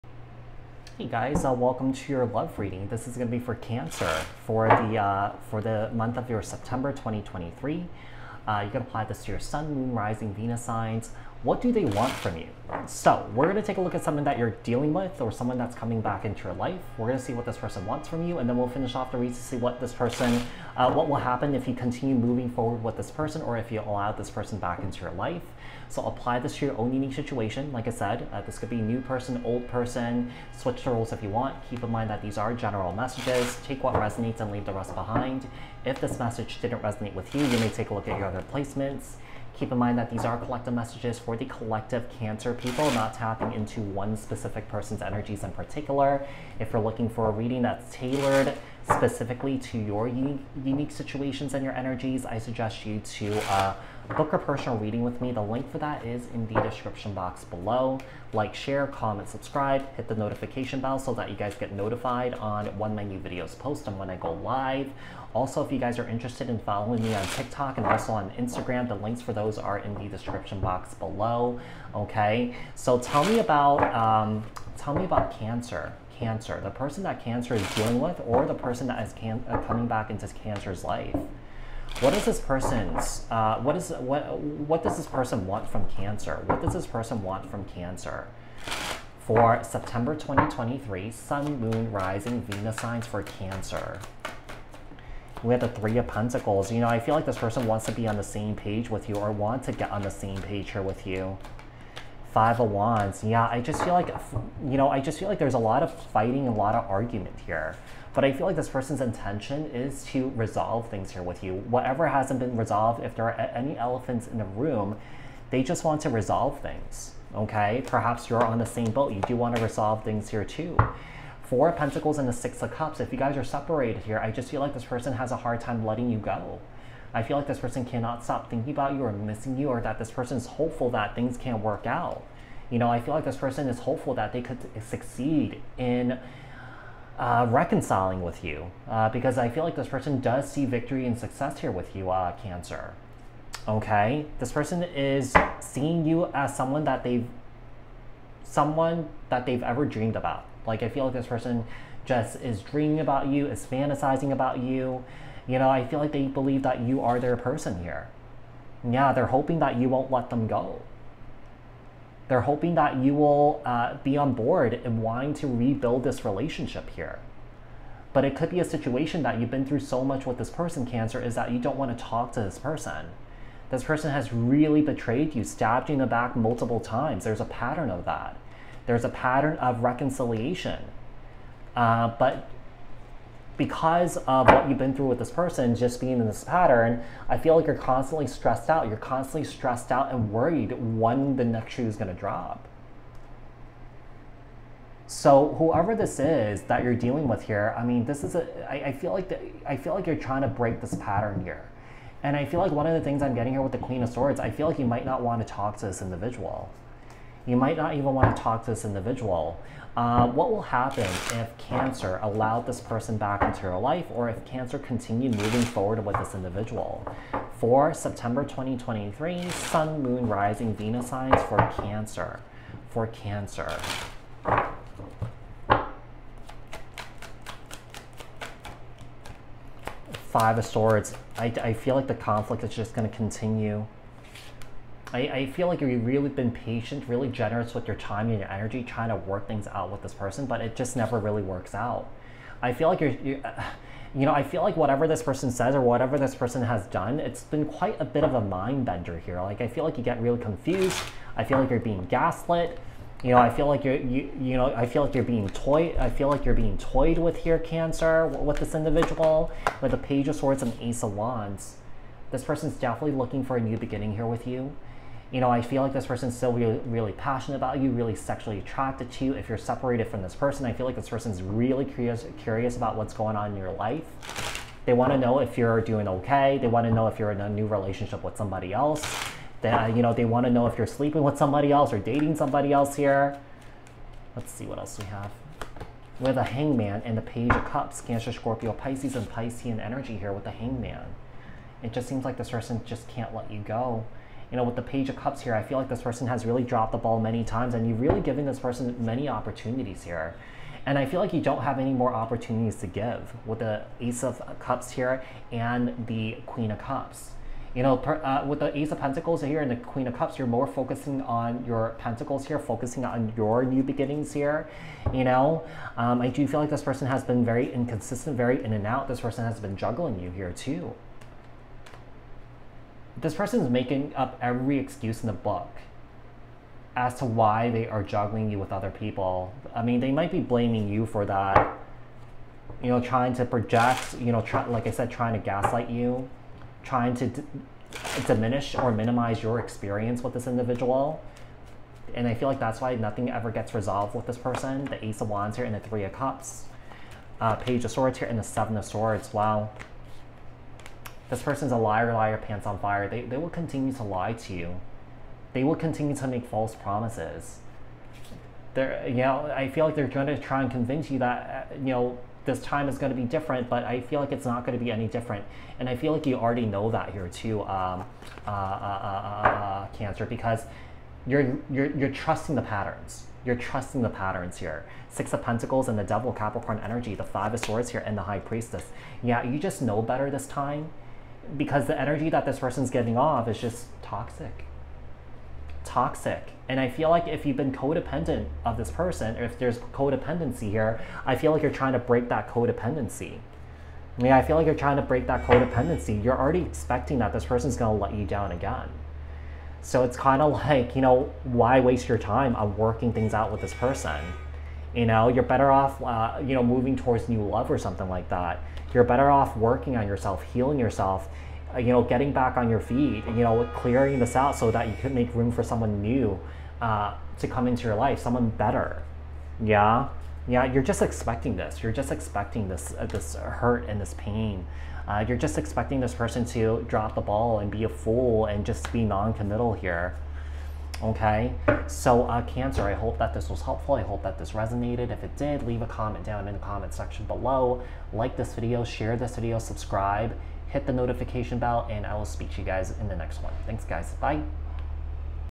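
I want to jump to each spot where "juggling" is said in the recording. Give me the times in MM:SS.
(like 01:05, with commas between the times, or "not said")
05:19, 05:28.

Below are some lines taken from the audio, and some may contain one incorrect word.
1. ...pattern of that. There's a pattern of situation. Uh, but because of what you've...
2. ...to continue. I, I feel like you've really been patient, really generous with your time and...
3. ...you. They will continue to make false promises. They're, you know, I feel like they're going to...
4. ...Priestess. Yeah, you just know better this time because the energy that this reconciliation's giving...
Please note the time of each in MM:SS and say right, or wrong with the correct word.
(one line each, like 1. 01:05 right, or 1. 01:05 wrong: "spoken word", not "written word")
1. 02:57 wrong: "reconciliation", not "situation"
2. 03:53 right
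3. 05:54 right
4. 06:18 wrong: "person", not "reconciliation".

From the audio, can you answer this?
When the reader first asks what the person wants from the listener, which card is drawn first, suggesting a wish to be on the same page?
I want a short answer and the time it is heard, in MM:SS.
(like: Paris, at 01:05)
Three of Pentacles, at 01:35.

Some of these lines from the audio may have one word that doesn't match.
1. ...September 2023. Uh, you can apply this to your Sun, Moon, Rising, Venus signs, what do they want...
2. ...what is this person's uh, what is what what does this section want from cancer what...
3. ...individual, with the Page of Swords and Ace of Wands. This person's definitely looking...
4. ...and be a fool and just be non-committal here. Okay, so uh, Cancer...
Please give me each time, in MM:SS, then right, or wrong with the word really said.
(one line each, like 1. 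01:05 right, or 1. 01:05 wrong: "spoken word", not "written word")
1. 00:06 right
2. 01:21 wrong: "person", not "section"
3. 04:18 right
4. 07:07 right.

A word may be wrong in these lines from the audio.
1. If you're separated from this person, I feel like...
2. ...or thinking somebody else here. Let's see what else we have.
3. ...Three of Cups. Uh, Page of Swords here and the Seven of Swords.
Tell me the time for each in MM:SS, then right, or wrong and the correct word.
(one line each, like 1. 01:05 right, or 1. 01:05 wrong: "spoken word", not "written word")
1. 04:29 right
2. 04:41 wrong: "dating", not "thinking"
3. 05:45 right.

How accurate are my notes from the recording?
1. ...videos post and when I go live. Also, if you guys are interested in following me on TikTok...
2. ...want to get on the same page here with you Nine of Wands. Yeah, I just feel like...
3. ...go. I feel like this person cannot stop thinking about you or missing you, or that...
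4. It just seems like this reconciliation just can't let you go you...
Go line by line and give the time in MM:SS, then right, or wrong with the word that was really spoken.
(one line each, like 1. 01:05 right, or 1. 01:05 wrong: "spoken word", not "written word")
1. 01:03 right
2. 01:39 wrong: "Five", not "Nine"
3. 02:06 right
4. 04:51 wrong: "person", not "reconciliation".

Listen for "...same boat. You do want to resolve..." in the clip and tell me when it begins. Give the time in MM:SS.
01:58.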